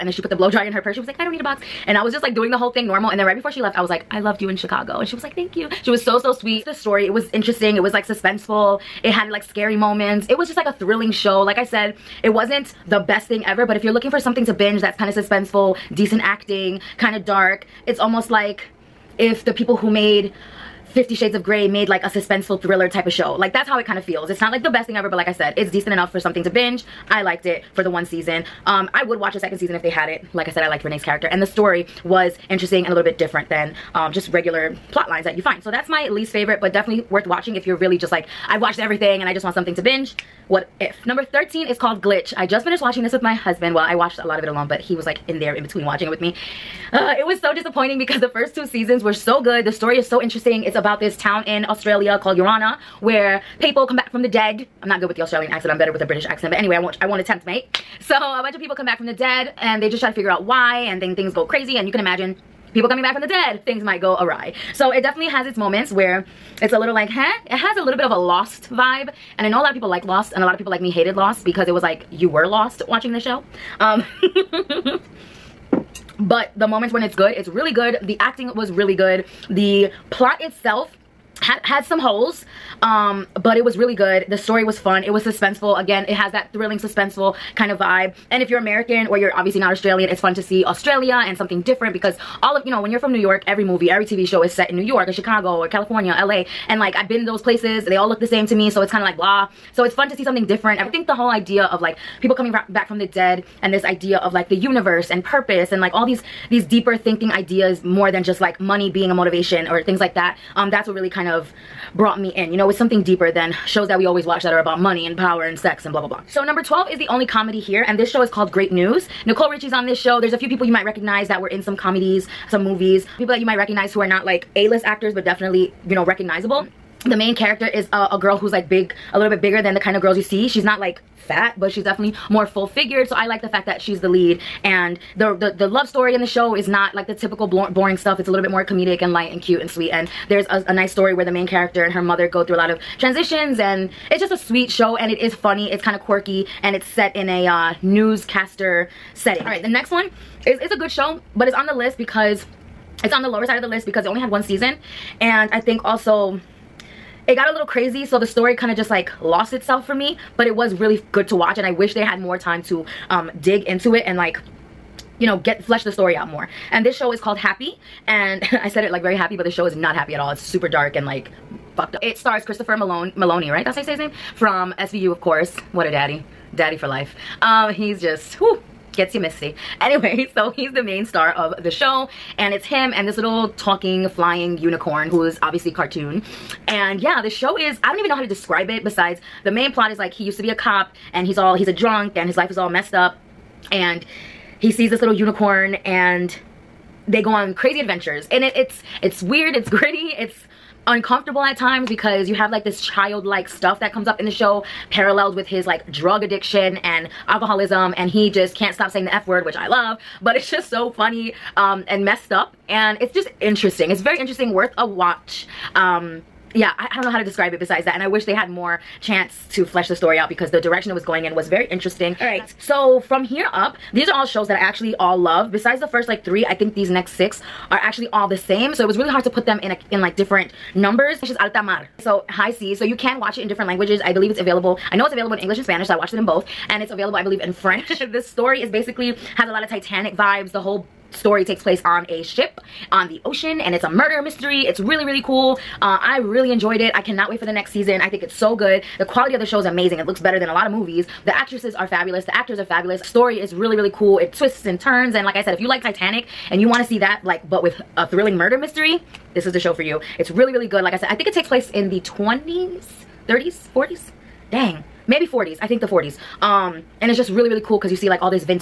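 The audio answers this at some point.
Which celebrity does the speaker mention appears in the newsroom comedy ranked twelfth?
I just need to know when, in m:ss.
1:59.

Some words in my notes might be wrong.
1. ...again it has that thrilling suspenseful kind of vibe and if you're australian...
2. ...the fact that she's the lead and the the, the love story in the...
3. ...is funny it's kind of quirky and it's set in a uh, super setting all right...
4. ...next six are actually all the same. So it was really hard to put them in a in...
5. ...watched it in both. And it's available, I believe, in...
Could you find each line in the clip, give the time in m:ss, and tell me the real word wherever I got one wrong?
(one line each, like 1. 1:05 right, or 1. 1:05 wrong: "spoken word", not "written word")
1. 1:25 wrong: "american", not "australian"
2. 2:13 right
3. 2:25 wrong: "newscaster", not "super"
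4. 3:46 right
5. 3:55 right.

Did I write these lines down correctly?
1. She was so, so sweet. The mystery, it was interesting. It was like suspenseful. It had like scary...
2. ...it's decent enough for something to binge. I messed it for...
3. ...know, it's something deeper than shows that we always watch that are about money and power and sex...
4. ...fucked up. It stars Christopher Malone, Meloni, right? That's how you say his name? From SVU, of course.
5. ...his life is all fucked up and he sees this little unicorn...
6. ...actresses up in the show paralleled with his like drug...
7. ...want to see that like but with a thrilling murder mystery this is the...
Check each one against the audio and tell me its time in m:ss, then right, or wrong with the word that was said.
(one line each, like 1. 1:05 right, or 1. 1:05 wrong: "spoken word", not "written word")
1. 0:05 wrong: "story", not "mystery"
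2. 0:25 wrong: "liked", not "messed"
3. 1:52 right
4. 2:51 right
5. 3:12 wrong: "messed", not "fucked"
6. 3:23 wrong: "comes", not "actresses"
7. 4:16 right.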